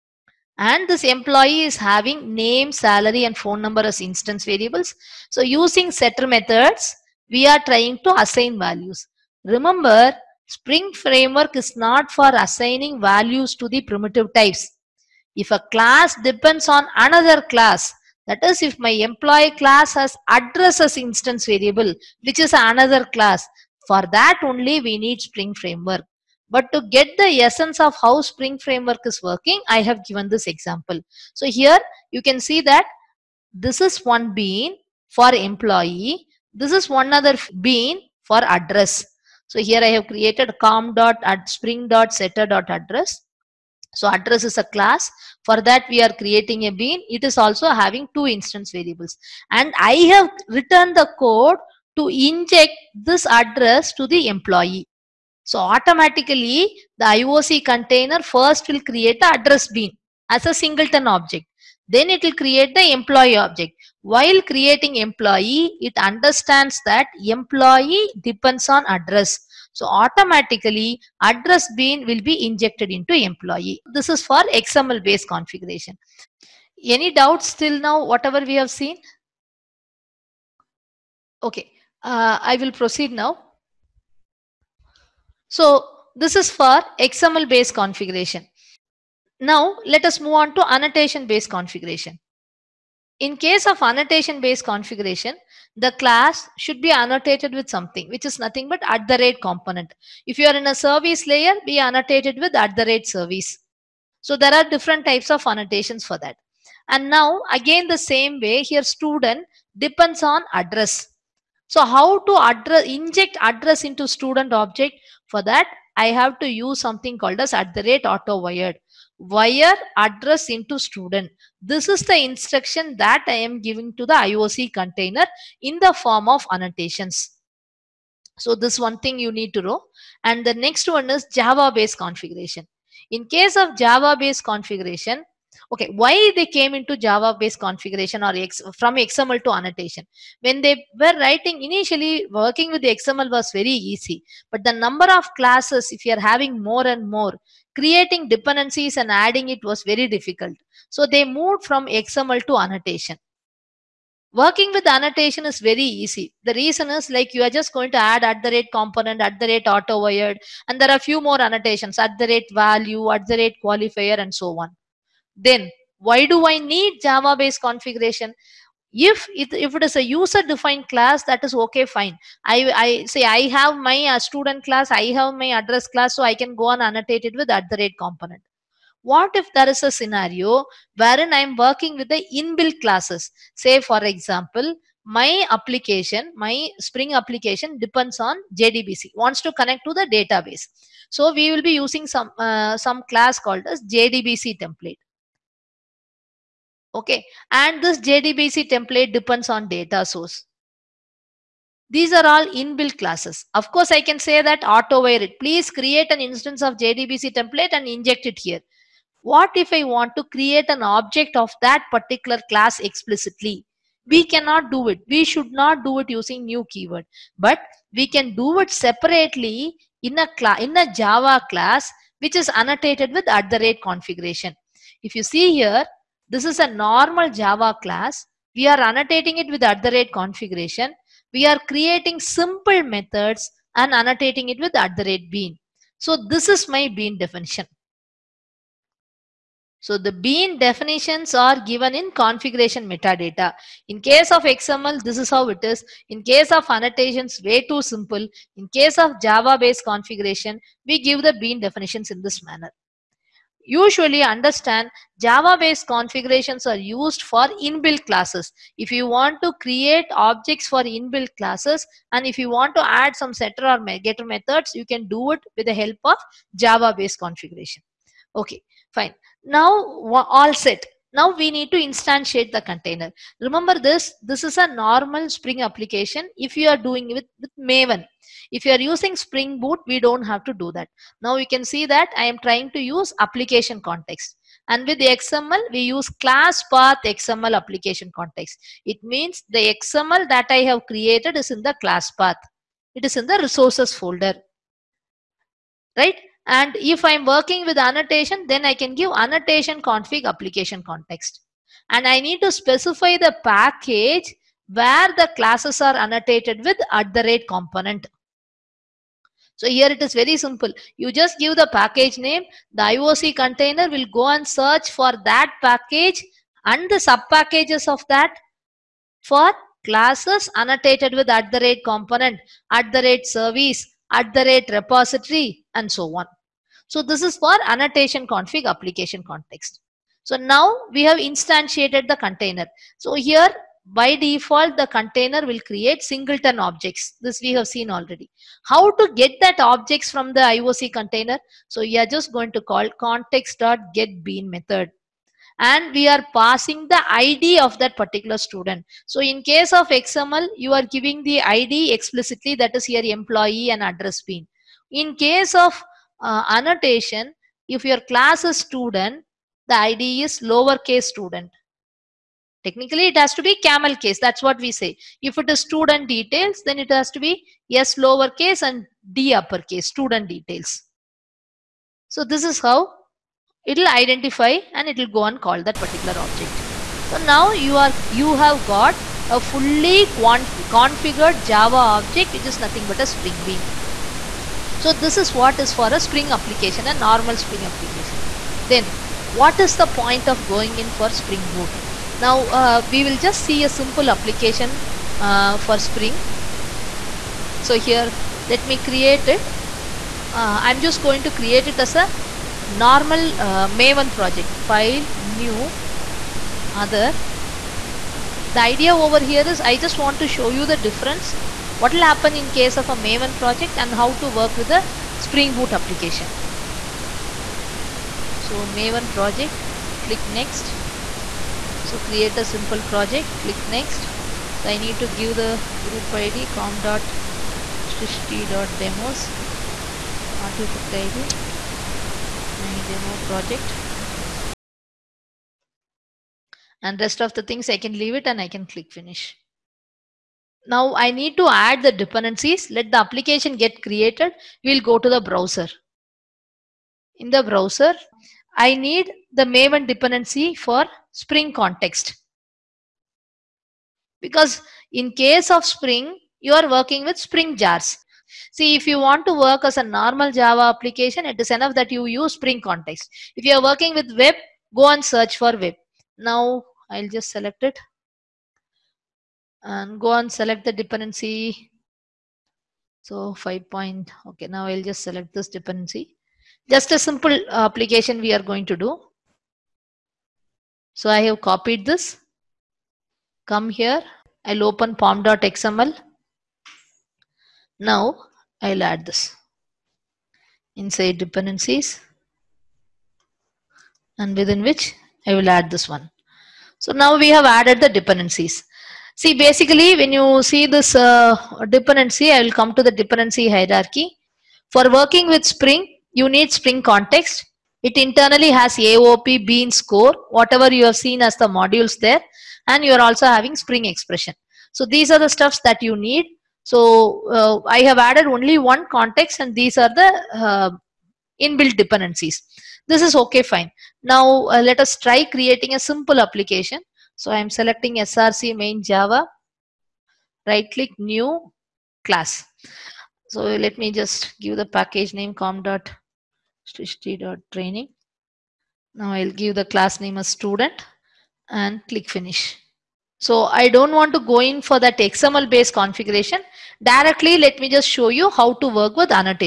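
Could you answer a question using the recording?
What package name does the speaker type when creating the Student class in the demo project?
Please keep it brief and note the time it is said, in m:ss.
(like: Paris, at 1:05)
training, at 8:55.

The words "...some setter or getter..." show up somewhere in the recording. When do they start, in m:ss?
4:23.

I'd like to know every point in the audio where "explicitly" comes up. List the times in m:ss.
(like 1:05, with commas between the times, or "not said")
3:32, 5:51.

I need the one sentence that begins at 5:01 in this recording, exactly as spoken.
And I need to specify the package where the classes are annotated with at the rate component.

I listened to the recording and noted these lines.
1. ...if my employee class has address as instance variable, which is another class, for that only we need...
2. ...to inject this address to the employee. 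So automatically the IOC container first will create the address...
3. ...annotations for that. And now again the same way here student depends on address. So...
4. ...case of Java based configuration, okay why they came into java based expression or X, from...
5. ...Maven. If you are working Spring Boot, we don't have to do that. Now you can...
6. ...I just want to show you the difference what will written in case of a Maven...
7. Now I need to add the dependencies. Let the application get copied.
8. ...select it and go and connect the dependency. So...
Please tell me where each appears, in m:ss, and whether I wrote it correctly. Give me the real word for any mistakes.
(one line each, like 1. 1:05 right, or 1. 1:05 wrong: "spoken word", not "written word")
1. 0:18 right
2. 0:51 right
3. 1:45 right
4. 2:13 wrong: "configuration", not "expression"
5. 4:37 wrong: "using", not "working"
6. 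6:49 wrong: "happen", not "written"
7. 7:20 wrong: "created", not "copied"
8. 7:47 wrong: "select", not "connect".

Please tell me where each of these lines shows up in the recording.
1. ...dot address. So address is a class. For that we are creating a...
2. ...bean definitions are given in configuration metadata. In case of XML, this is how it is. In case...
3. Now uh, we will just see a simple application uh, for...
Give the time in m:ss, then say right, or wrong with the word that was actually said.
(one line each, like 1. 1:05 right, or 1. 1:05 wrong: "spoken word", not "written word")
1. 0:42 right
2. 4:00 right
3. 6:32 right.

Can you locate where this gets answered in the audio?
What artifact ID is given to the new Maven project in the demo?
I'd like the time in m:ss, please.
7:12.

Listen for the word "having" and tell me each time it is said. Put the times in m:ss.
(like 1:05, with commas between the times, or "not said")
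0:01, 0:47, 2:26, 8:33.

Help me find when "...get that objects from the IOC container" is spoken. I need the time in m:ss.
5:39.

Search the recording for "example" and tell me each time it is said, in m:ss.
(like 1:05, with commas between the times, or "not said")
0:30, 3:04.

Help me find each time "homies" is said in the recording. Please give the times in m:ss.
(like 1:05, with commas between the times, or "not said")
not said.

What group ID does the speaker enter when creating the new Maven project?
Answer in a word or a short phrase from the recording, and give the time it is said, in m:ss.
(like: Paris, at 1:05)
demos, at 7:08.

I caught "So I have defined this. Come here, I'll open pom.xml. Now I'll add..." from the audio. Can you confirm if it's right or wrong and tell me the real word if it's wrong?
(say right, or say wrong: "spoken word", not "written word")
wrong: "copied", not "defined".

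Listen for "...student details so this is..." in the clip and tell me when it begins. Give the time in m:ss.
6:09.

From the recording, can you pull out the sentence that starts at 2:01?
This is the instruction that I am giving to the IOC container in the form of annotations.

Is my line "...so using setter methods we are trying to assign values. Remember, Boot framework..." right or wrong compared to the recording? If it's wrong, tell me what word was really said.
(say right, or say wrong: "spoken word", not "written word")
wrong: "Spring", not "Boot".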